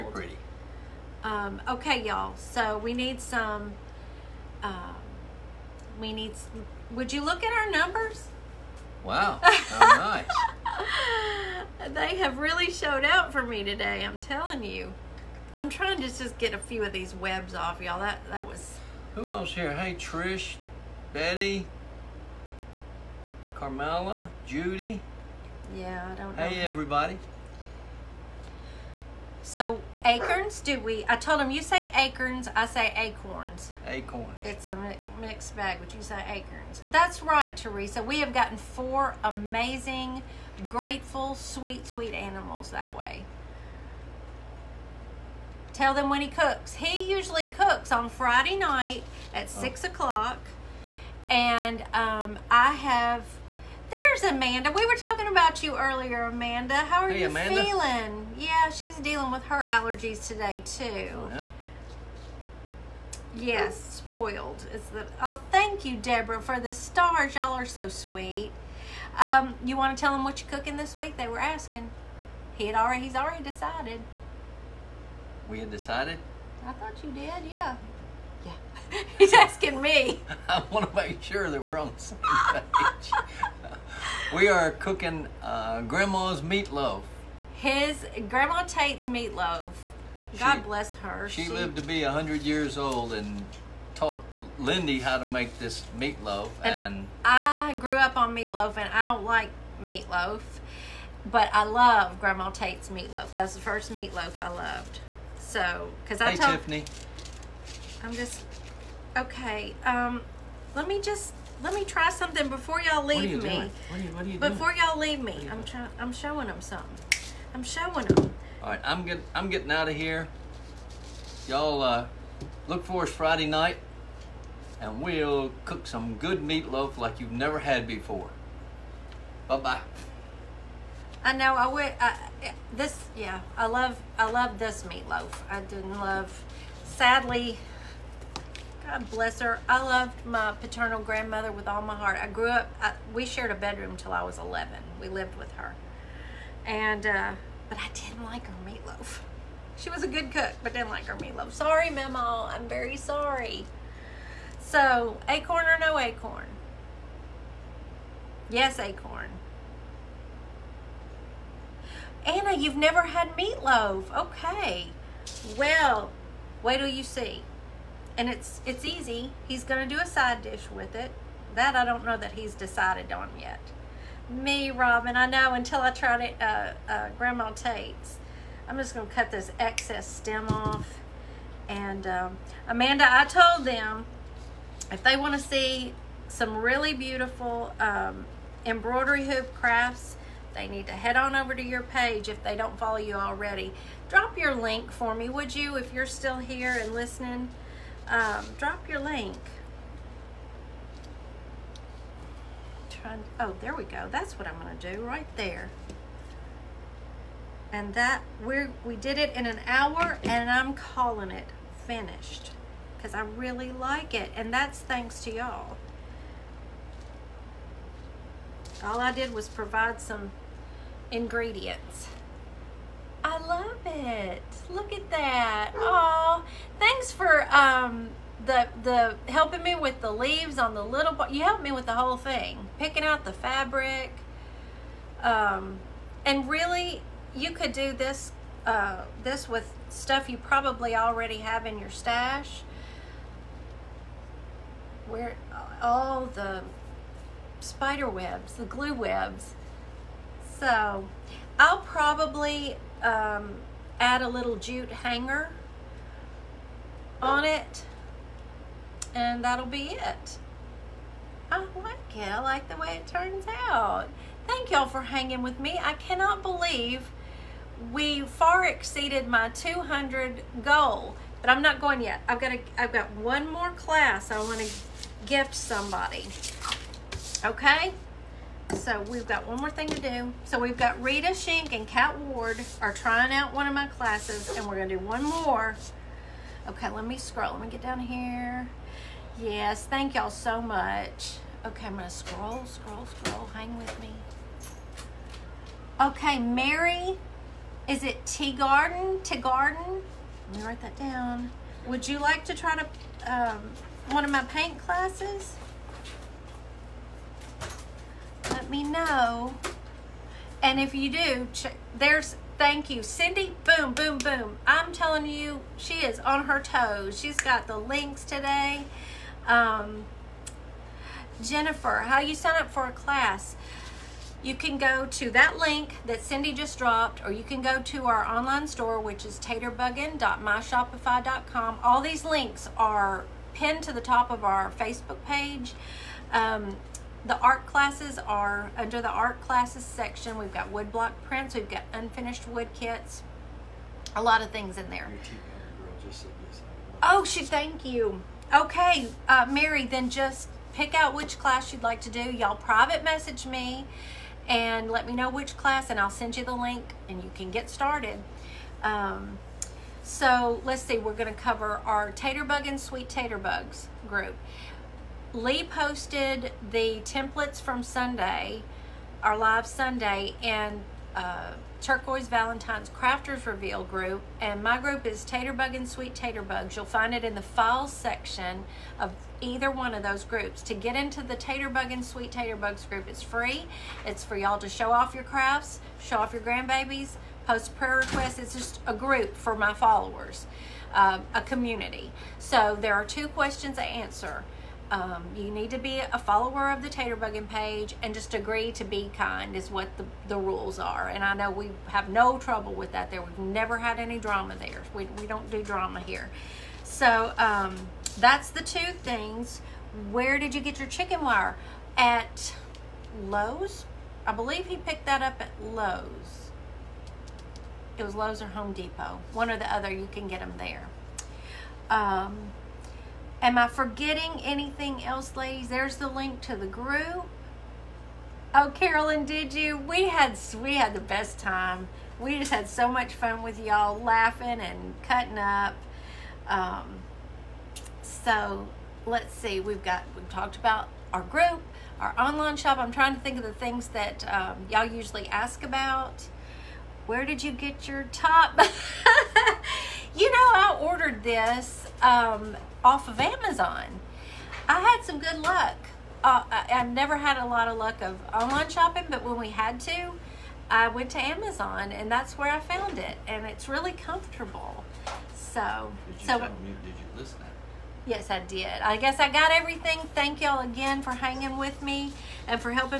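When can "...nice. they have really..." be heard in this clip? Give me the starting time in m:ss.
0:11.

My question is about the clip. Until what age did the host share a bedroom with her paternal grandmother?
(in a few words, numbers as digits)
11.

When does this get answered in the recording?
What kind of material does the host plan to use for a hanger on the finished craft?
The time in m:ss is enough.
4:14.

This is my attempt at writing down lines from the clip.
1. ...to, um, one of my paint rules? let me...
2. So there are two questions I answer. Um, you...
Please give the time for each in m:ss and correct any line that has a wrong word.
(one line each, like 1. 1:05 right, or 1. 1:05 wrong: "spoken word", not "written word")
1. 5:02 wrong: "classes", not "rules"
2. 6:32 right.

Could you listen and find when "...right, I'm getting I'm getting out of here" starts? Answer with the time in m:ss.
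1:58.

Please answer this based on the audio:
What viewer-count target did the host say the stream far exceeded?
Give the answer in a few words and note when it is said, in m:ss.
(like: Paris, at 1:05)
200, at 4:29.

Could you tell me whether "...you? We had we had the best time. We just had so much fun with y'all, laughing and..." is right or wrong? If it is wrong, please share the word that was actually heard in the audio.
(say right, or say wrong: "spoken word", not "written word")
right.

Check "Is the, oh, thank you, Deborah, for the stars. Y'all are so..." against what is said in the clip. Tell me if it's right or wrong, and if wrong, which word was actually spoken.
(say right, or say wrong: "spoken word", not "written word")
right.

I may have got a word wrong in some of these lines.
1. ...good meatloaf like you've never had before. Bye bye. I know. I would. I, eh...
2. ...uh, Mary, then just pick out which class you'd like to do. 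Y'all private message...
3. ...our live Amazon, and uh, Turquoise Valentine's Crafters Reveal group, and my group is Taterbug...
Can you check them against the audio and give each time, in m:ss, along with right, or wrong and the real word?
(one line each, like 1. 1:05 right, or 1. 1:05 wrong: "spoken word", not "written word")
1. 2:06 right
2. 5:49 right
3. 6:09 wrong: "Sunday", not "Amazon".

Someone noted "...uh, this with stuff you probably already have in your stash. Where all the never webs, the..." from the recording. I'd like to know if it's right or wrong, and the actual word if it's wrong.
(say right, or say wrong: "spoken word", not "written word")
wrong: "spider", not "never".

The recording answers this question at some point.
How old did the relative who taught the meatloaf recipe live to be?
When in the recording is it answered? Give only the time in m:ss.
1:32.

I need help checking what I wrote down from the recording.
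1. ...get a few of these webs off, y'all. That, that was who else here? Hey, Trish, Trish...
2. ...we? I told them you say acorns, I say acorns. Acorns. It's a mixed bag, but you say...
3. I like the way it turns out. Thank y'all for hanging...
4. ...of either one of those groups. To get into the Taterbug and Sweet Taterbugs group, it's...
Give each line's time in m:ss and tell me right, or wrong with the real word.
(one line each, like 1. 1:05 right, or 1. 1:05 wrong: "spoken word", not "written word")
1. 0:16 wrong: "Betty", not "Trish"
2. 0:30 right
3. 4:22 right
4. 6:18 right.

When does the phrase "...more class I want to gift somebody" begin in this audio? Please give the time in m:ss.
4:33.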